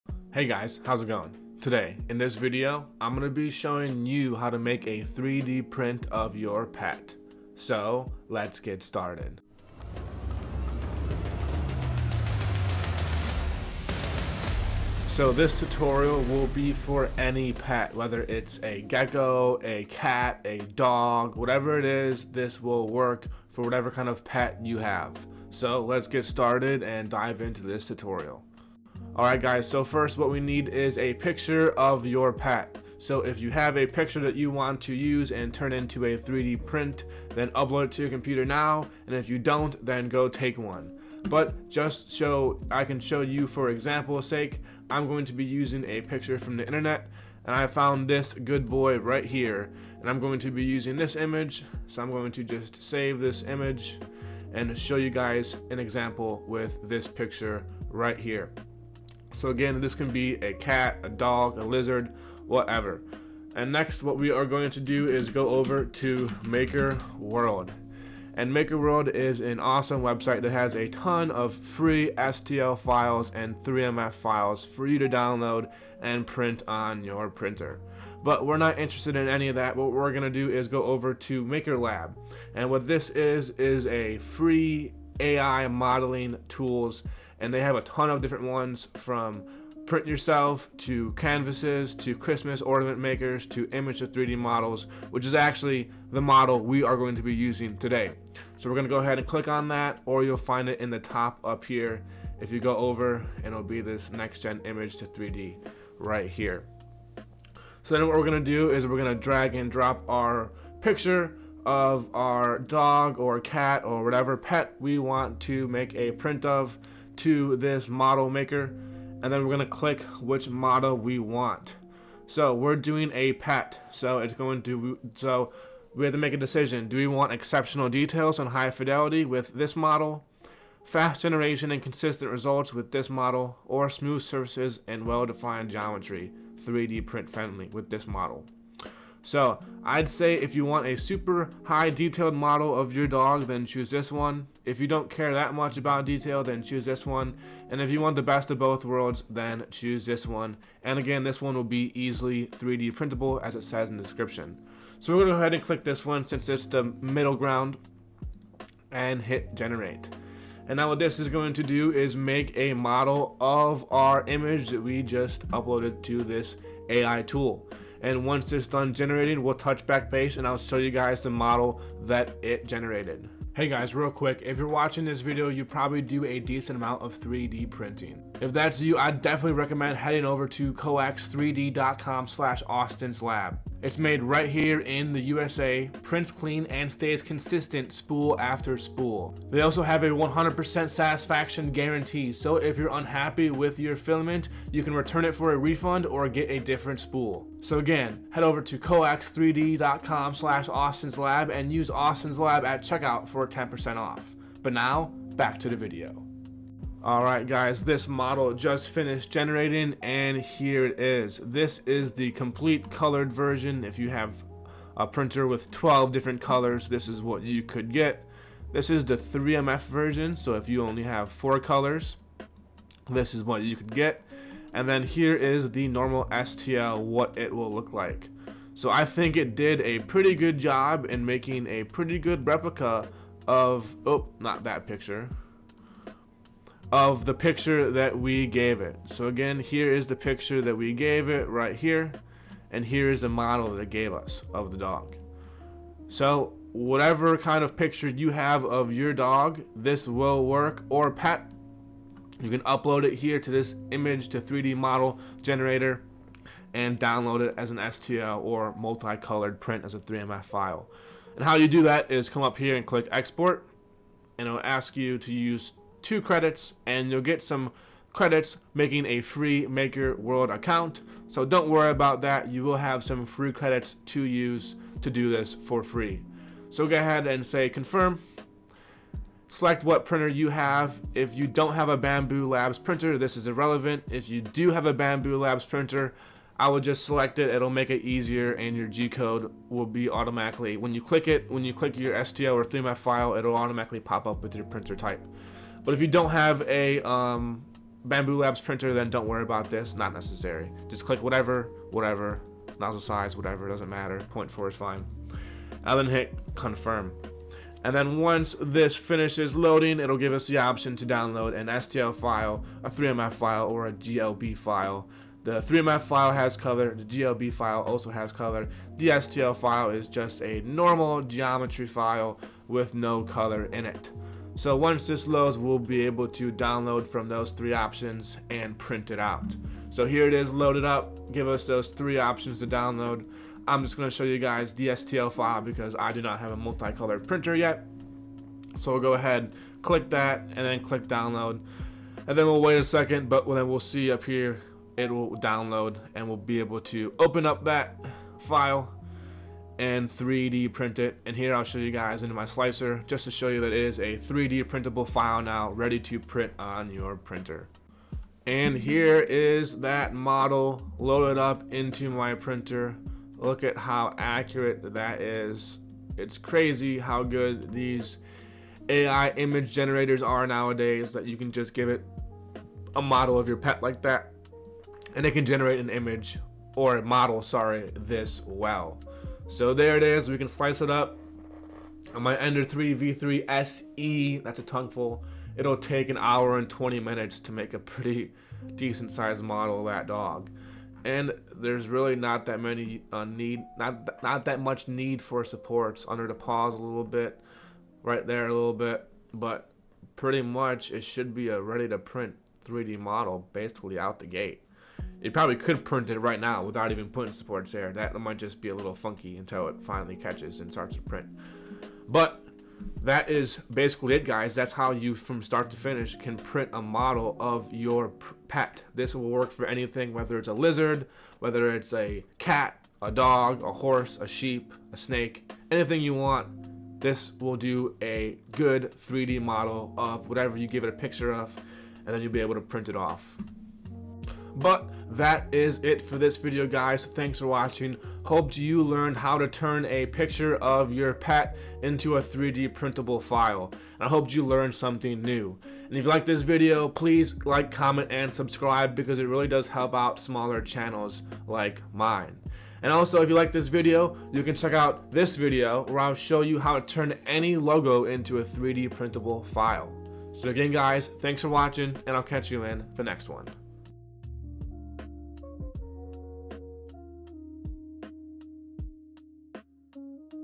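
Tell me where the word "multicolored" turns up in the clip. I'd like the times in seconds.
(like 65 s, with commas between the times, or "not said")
258 s, 336 s.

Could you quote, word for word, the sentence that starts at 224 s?
And then here is the normal STL, what it will look like.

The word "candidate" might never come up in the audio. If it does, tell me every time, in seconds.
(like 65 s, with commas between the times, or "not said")
not said.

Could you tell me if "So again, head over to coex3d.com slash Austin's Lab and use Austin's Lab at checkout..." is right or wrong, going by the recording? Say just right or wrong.
right.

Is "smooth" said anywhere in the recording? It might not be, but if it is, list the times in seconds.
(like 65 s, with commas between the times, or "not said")
133 s.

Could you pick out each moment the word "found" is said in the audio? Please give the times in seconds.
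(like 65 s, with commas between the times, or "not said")
47 s.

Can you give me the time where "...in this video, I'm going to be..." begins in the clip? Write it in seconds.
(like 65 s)
2 s.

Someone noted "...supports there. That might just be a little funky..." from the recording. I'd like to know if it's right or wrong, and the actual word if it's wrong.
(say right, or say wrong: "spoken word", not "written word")
right.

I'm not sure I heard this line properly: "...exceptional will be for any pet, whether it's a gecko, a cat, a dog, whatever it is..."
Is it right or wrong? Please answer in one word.
wrong.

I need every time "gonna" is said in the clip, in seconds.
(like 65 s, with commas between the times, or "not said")
155 s, 333 s.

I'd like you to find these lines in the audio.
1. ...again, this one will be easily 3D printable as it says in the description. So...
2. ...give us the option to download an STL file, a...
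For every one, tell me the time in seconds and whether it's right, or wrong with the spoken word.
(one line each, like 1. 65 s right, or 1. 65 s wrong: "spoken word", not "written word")
1. 150 s right
2. 310 s right.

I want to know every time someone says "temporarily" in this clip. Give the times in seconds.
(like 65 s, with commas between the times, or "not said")
not said.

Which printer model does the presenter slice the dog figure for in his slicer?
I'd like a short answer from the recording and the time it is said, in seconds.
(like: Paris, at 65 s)
Ender 3 V3 SE, at 382 s.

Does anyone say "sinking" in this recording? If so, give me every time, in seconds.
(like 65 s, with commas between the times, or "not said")
not said.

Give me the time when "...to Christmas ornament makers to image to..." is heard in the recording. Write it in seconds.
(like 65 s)
91 s.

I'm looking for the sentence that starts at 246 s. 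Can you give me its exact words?
So whatever kind of picture you have of your dog, this will work, or pet.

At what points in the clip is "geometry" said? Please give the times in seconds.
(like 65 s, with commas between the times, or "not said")
135 s, 321 s.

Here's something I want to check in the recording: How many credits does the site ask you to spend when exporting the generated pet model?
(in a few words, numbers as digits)
2.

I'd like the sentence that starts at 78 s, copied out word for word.
But we're not interested in any of that.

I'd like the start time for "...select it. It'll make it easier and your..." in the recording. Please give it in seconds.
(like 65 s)
287 s.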